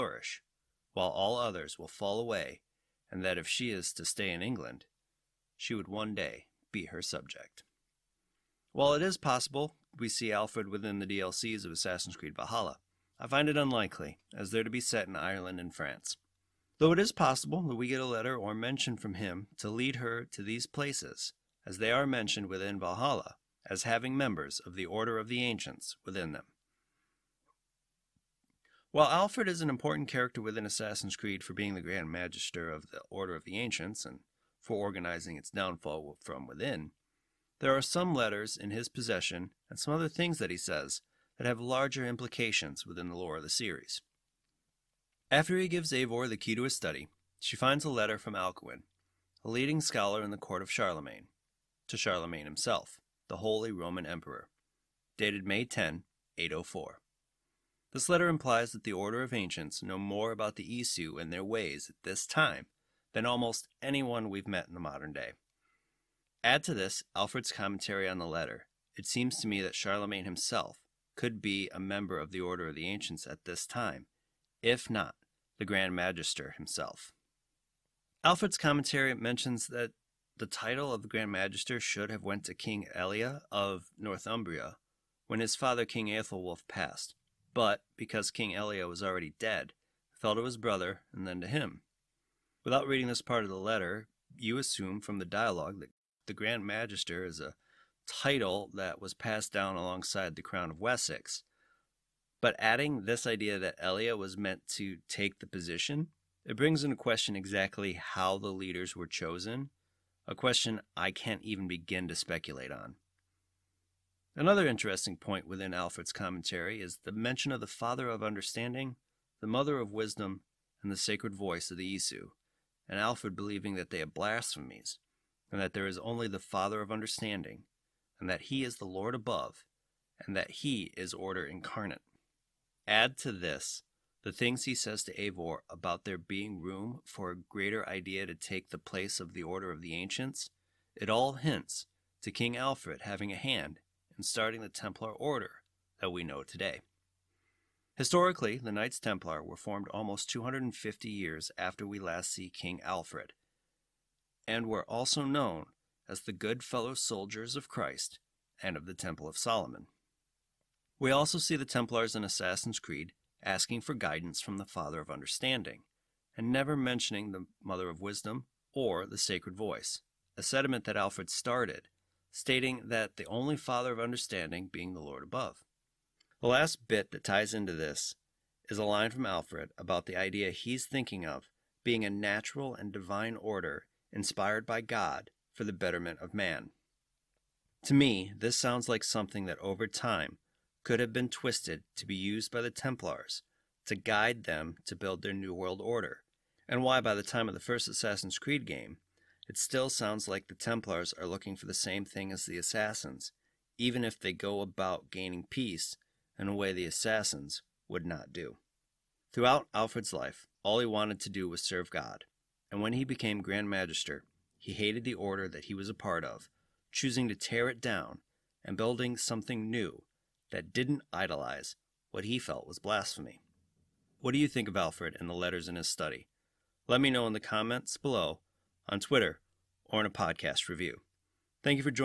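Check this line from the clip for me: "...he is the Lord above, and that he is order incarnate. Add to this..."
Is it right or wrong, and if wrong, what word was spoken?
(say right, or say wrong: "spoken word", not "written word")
right.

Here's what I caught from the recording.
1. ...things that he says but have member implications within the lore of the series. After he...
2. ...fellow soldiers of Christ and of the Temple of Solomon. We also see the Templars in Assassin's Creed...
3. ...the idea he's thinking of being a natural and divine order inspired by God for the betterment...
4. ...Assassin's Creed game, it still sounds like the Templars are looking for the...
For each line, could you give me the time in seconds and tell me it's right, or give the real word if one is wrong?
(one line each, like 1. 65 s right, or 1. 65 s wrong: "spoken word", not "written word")
1. 40 s wrong: "larger", not "member"
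2. 156 s right
3. 180 s right
4. 197 s right.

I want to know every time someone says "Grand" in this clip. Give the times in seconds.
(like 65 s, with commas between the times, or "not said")
31 s, 75 s, 81 s, 96 s, 213 s.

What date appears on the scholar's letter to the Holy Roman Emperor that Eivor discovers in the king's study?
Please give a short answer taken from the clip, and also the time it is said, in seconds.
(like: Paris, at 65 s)
May 10, 804, at 55 s.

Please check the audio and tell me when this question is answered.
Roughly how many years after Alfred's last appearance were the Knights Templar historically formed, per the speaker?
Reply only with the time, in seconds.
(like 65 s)
150 s.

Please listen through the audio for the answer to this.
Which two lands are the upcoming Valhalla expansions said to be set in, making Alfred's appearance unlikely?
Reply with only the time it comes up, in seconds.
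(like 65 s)
15 s.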